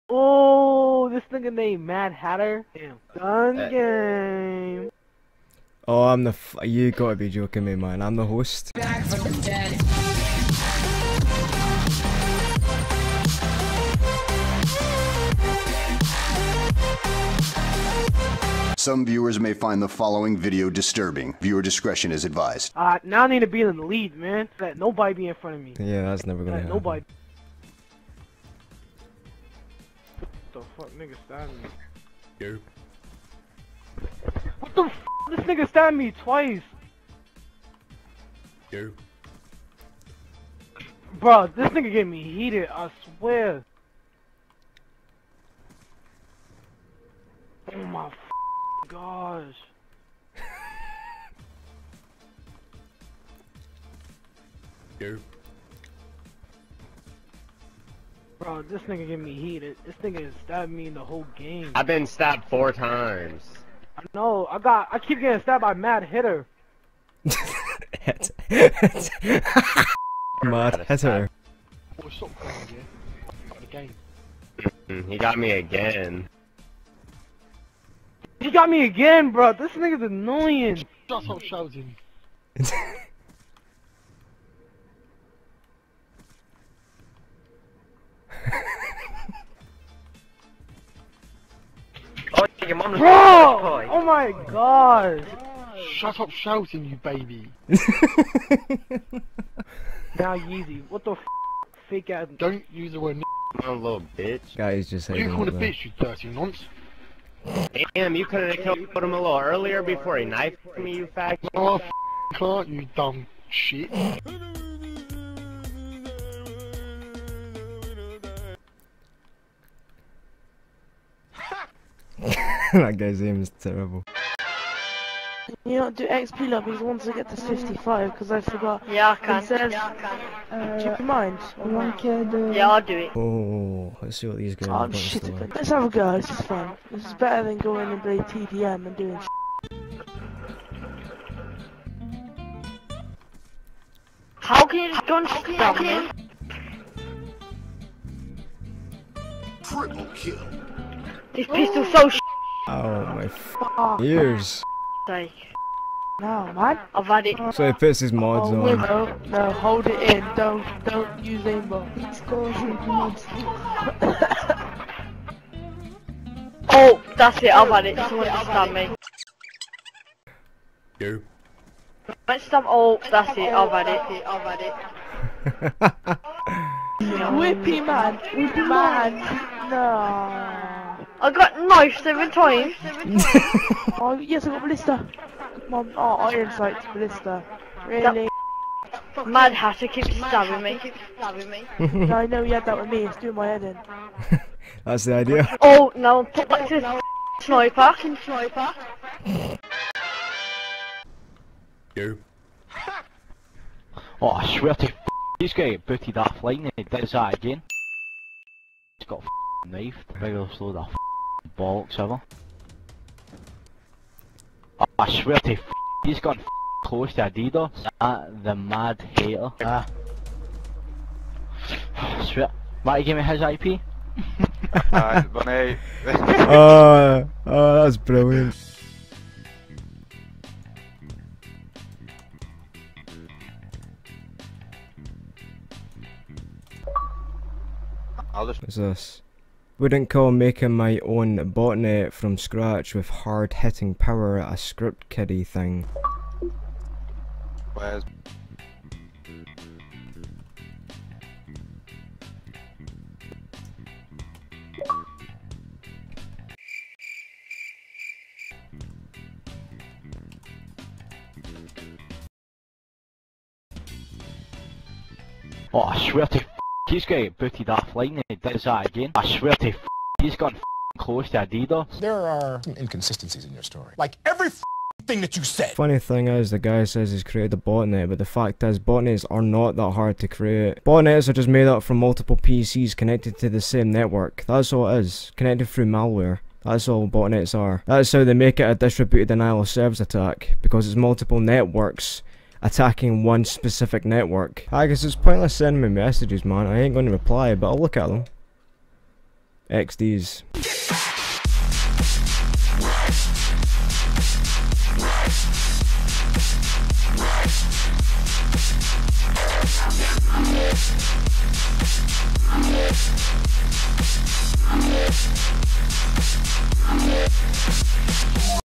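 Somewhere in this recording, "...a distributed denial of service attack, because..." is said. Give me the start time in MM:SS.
04:48.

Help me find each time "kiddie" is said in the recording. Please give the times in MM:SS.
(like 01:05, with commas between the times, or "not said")
04:05.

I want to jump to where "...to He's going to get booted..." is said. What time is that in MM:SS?
04:26.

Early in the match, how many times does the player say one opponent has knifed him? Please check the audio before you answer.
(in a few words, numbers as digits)
4.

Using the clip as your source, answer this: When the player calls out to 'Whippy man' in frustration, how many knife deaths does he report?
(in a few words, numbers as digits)
7.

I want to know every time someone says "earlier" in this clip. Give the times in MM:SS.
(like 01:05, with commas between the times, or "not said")
01:49.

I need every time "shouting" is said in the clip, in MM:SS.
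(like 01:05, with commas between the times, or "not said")
01:21, 01:36.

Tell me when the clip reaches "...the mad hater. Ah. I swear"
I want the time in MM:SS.
03:38.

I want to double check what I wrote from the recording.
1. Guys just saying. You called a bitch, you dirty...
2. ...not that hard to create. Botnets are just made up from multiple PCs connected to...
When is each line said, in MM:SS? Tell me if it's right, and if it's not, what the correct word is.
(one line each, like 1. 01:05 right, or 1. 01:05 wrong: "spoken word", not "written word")
1. 01:44 right
2. 04:39 right.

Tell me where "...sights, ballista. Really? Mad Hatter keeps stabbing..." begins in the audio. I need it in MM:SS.
03:06.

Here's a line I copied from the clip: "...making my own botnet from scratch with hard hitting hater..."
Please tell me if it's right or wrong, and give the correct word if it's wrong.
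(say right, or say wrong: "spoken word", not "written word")
wrong: "power", not "hater".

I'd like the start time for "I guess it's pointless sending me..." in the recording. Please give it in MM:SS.
04:54.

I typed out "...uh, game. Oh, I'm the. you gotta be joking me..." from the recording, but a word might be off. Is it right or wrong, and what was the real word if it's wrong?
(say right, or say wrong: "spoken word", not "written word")
right.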